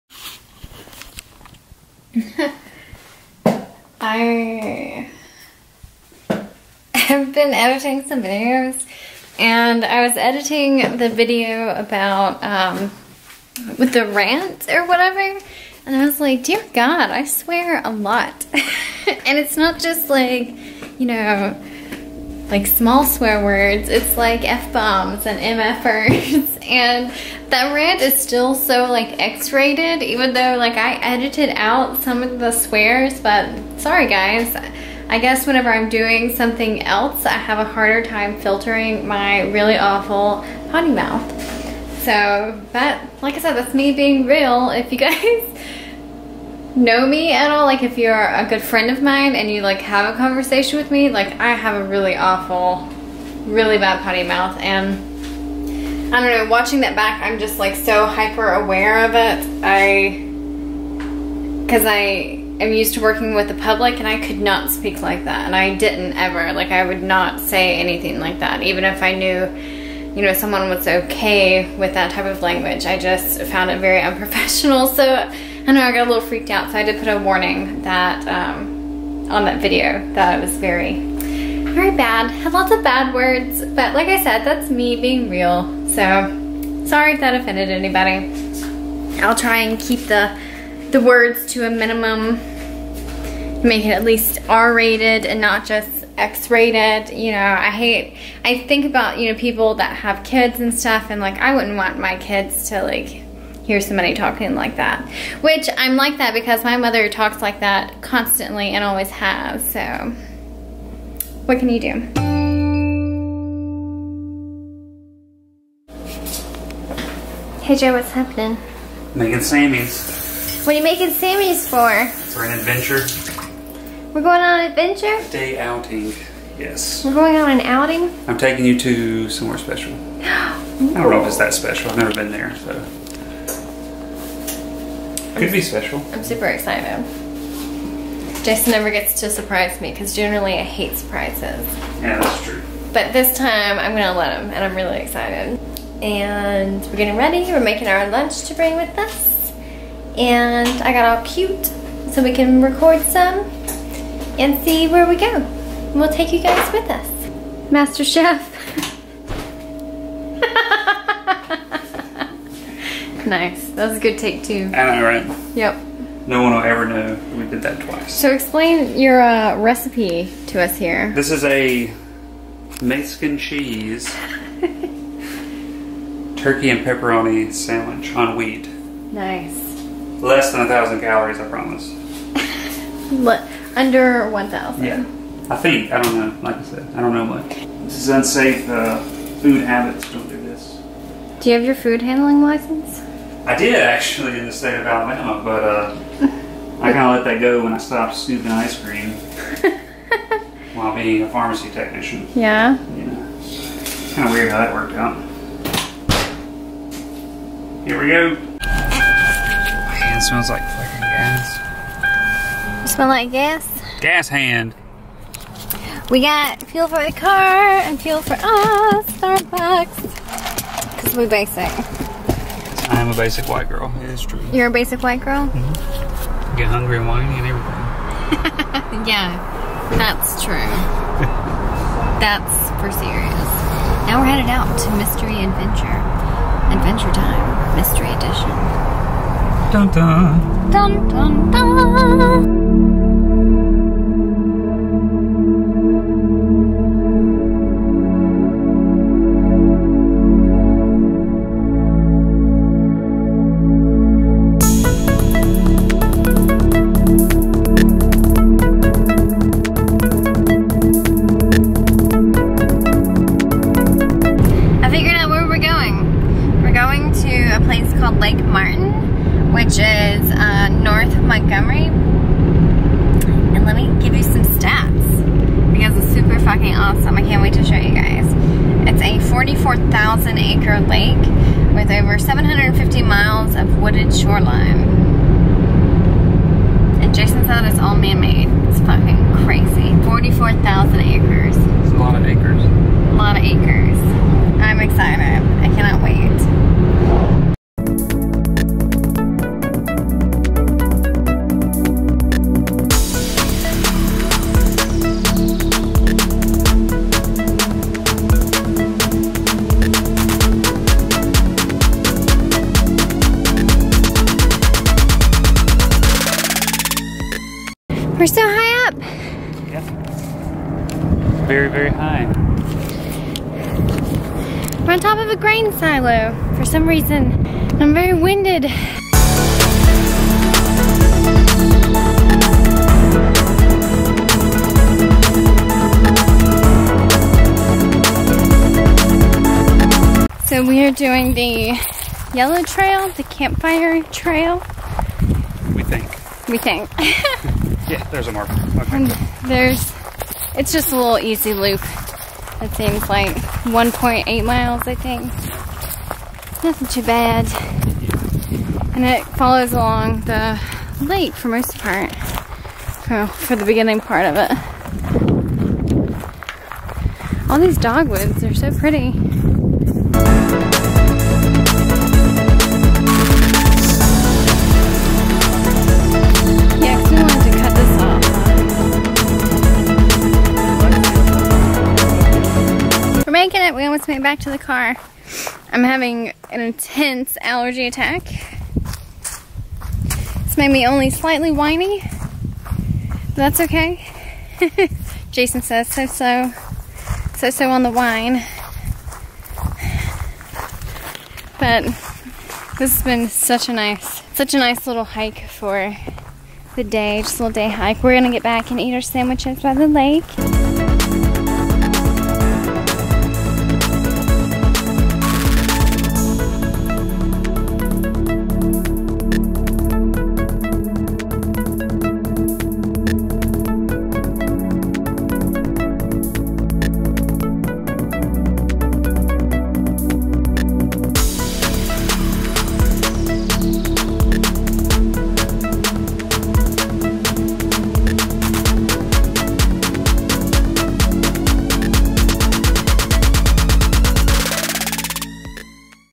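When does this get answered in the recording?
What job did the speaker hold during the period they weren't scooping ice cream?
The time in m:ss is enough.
3:21.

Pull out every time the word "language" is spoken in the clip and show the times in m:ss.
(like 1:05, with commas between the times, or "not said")
1:12.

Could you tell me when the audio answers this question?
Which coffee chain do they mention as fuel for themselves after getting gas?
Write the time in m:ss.
3:39.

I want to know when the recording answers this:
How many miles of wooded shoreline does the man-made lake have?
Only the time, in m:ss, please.
4:41.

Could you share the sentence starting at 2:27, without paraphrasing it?
We're making our lunch to bring with us.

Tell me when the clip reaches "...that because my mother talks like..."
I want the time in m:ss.
1:46.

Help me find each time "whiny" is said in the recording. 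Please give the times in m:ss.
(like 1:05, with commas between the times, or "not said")
3:47, 6:31.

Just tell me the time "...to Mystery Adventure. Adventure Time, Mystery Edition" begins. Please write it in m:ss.
3:54.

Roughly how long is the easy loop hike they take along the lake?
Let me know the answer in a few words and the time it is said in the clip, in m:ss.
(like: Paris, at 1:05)
1.8 miles, at 5:53.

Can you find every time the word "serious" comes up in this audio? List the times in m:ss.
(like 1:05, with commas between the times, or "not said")
3:53.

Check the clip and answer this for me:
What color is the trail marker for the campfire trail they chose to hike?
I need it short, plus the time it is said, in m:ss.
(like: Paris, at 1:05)
yellow, at 5:42.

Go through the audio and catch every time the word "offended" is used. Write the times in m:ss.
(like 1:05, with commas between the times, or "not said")
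1:27.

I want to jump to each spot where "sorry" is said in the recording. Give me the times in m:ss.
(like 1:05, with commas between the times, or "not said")
0:33, 1:26.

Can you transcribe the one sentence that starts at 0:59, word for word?
I, because I am used to working with the public and I could not speak like that.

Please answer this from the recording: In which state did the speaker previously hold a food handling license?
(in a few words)
Alabama.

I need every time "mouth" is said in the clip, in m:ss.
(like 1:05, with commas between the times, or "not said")
0:40, 0:54.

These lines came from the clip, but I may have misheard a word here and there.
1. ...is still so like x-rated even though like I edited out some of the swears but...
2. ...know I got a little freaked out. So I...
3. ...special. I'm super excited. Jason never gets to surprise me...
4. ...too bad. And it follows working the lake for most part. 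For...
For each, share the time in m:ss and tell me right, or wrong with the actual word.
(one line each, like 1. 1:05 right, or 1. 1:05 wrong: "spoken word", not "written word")
1. 0:28 right
2. 1:15 right
3. 2:15 right
4. 5:56 wrong: "along", not "working".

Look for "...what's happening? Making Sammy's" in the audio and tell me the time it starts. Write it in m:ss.
1:57.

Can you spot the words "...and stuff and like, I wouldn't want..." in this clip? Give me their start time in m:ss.
1:40.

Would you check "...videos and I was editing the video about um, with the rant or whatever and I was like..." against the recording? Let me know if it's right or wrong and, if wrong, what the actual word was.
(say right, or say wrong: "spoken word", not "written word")
right.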